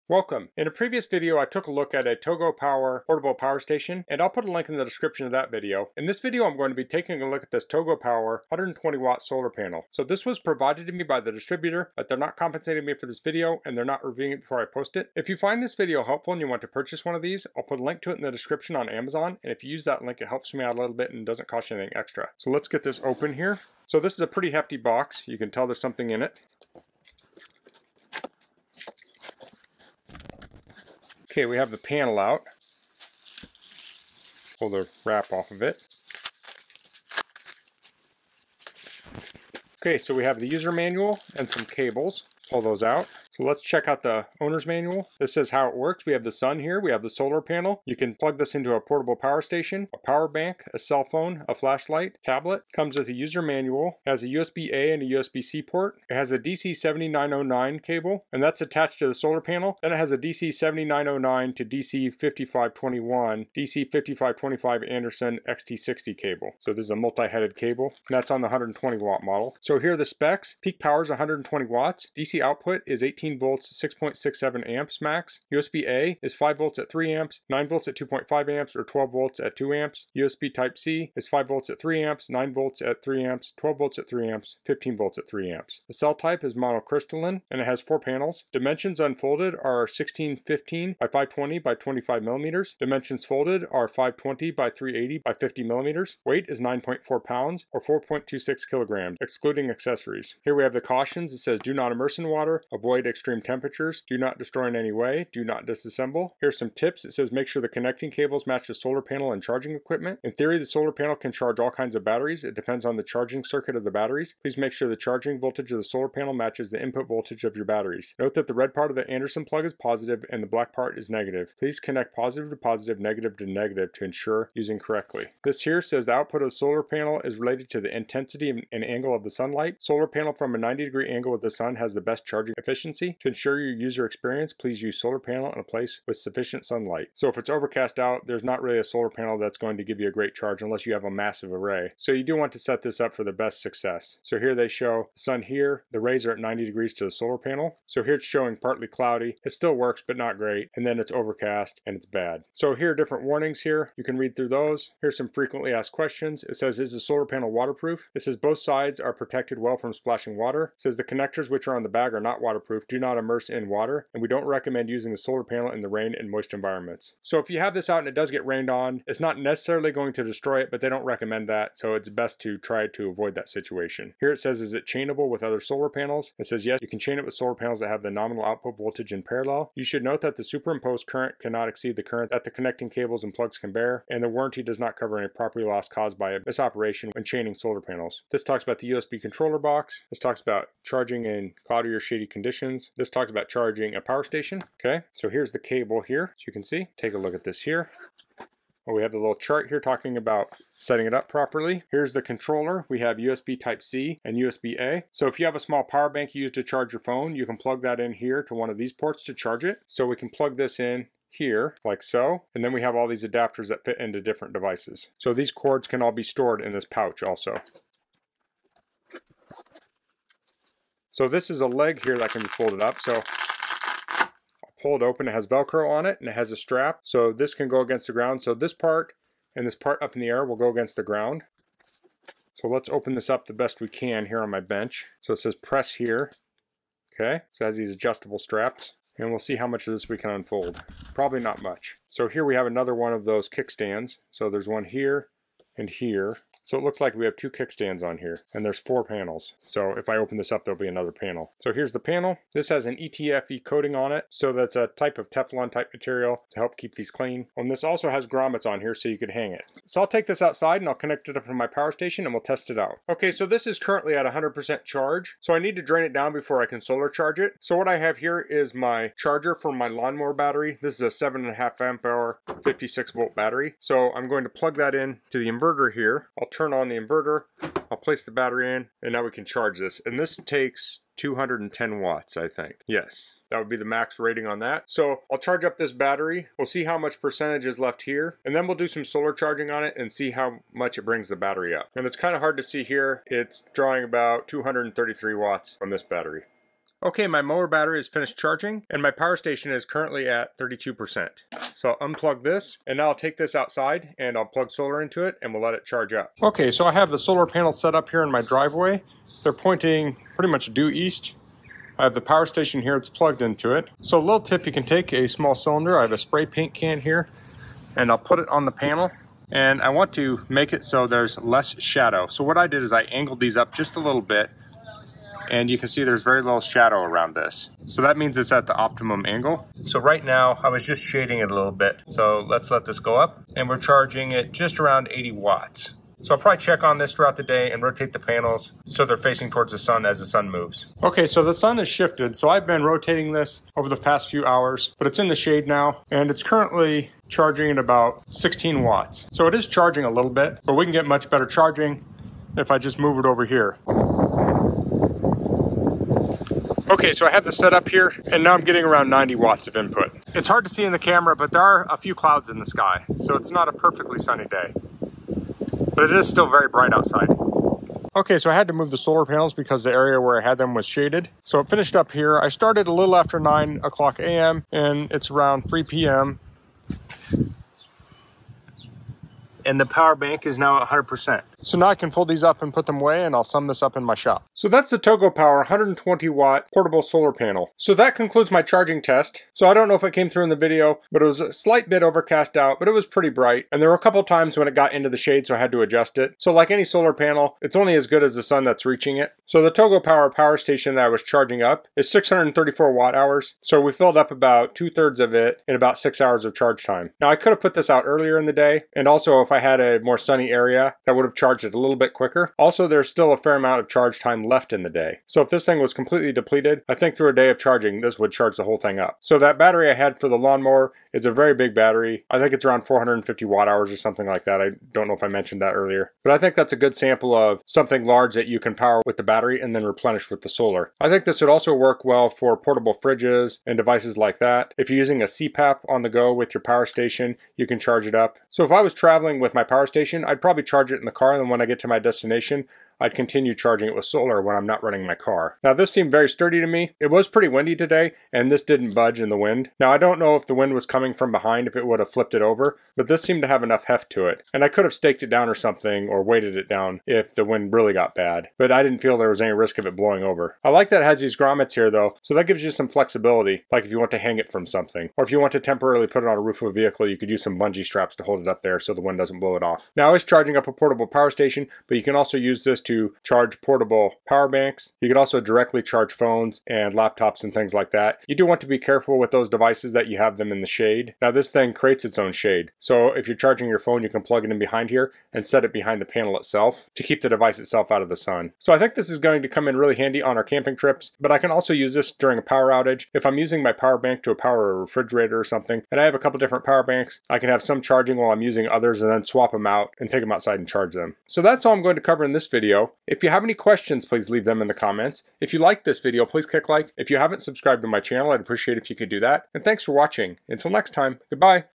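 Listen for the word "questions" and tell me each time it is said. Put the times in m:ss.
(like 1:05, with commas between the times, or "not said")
2:35, 8:23.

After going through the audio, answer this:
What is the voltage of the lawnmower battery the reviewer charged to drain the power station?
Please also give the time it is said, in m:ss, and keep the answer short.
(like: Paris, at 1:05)
56 volts, at 4:32.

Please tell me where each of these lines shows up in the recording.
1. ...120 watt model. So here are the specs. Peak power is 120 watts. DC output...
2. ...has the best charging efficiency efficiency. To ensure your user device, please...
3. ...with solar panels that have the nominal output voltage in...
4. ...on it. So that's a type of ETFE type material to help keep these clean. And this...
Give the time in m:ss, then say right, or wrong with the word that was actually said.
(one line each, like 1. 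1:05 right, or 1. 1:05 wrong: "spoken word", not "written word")
1. 1:08 right
2. 2:11 wrong: "experience", not "device"
3. 2:57 right
4. 4:13 wrong: "Teflon", not "ETFE".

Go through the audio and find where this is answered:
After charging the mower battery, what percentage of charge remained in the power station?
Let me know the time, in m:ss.
5:00.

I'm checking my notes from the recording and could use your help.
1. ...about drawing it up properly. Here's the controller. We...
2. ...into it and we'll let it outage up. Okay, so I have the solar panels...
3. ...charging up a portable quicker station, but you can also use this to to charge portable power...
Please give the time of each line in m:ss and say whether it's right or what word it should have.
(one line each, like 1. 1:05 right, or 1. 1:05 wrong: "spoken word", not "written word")
1. 3:20 wrong: "setting", not "drawing"
2. 5:05 wrong: "charge", not "outage"
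3. 7:50 wrong: "power", not "quicker".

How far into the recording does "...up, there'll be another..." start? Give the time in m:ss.
4:10.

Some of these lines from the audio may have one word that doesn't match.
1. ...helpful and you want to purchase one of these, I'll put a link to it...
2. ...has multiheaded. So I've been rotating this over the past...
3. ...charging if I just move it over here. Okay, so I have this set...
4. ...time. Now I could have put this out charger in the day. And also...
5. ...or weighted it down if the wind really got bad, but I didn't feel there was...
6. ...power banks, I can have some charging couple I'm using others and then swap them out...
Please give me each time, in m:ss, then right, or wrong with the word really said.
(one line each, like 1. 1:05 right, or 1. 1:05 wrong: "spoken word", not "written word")
1. 0:16 right
2. 5:41 wrong: "shifted", not "multiheaded"
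3. 5:51 right
4. 6:46 wrong: "earlier", not "charger"
5. 7:36 right
6. 8:16 wrong: "while", not "couple".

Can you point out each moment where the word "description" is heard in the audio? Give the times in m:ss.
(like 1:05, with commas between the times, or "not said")
0:04, 0:18.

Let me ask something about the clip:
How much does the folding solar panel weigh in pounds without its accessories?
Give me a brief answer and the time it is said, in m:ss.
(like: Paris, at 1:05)
9.4 pounds, at 1:36.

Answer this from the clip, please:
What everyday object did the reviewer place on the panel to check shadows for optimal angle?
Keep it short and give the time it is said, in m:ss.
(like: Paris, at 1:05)
spray paint can, at 5:16.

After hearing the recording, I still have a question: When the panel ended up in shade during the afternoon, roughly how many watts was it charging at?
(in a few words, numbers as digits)
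16 watts.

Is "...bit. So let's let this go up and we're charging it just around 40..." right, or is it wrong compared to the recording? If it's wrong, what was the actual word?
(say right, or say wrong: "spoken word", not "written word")
wrong: "80", not "40".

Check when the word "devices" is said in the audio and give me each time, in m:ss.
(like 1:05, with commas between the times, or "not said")
3:34, 7:13, 7:59, 8:07.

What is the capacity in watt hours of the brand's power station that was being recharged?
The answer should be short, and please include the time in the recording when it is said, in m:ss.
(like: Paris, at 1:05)
634 watt hours, at 6:42.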